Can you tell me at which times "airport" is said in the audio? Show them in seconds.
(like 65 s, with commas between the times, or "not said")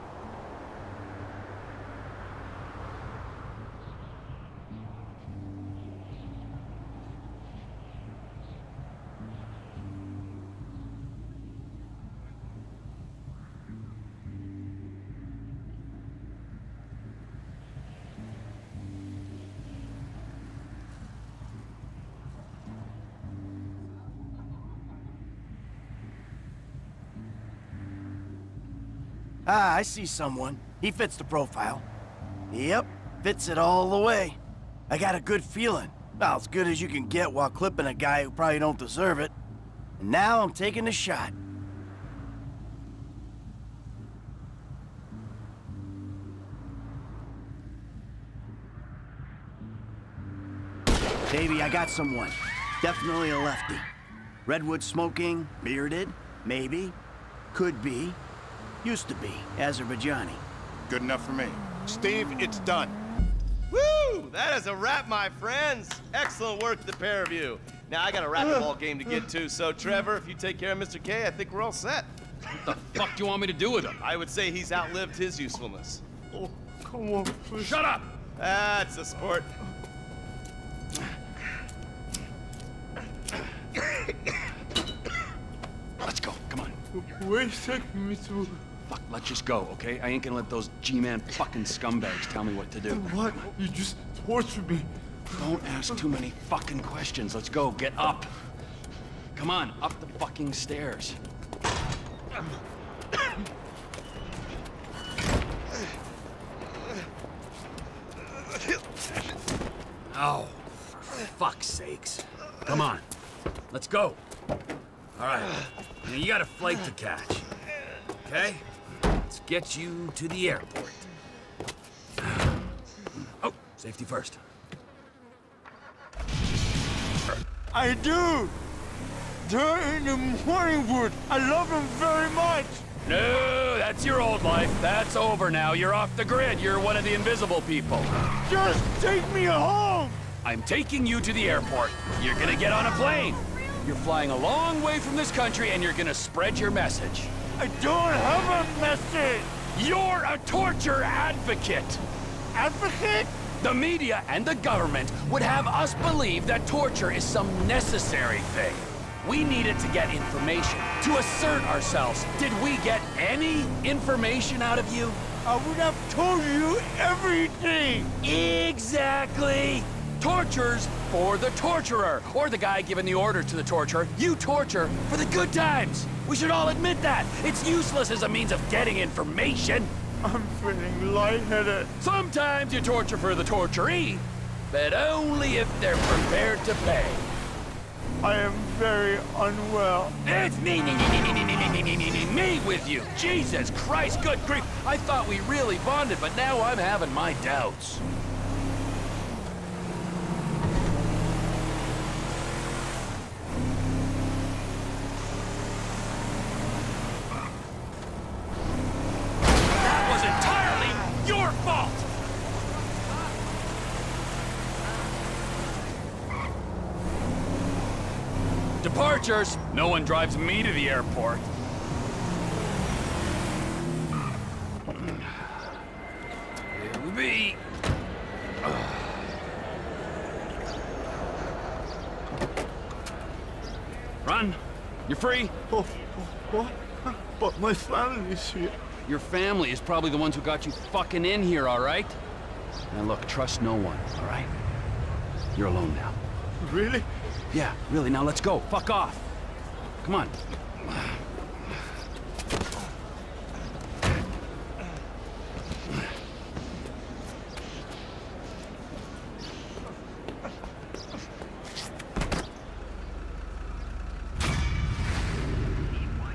120 s, 141 s, 220 s.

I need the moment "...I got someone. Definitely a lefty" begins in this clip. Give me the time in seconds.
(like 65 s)
51 s.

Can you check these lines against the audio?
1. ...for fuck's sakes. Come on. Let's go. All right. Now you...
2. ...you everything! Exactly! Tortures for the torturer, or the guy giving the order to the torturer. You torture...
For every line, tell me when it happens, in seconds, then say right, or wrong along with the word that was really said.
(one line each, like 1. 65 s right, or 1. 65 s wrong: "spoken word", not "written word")
1. 111 s right
2. 166 s right.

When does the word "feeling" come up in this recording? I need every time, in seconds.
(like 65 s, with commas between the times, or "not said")
35 s, 180 s.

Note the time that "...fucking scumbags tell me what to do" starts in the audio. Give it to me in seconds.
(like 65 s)
91 s.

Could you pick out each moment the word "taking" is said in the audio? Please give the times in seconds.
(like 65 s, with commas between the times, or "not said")
40 s, 140 s.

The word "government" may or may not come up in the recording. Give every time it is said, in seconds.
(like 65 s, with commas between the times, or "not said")
154 s.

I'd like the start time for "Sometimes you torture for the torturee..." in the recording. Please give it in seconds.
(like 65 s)
182 s.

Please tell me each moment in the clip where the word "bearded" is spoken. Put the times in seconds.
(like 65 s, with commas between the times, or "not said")
55 s.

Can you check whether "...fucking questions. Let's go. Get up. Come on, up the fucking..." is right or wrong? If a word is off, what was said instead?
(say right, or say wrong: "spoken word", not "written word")
right.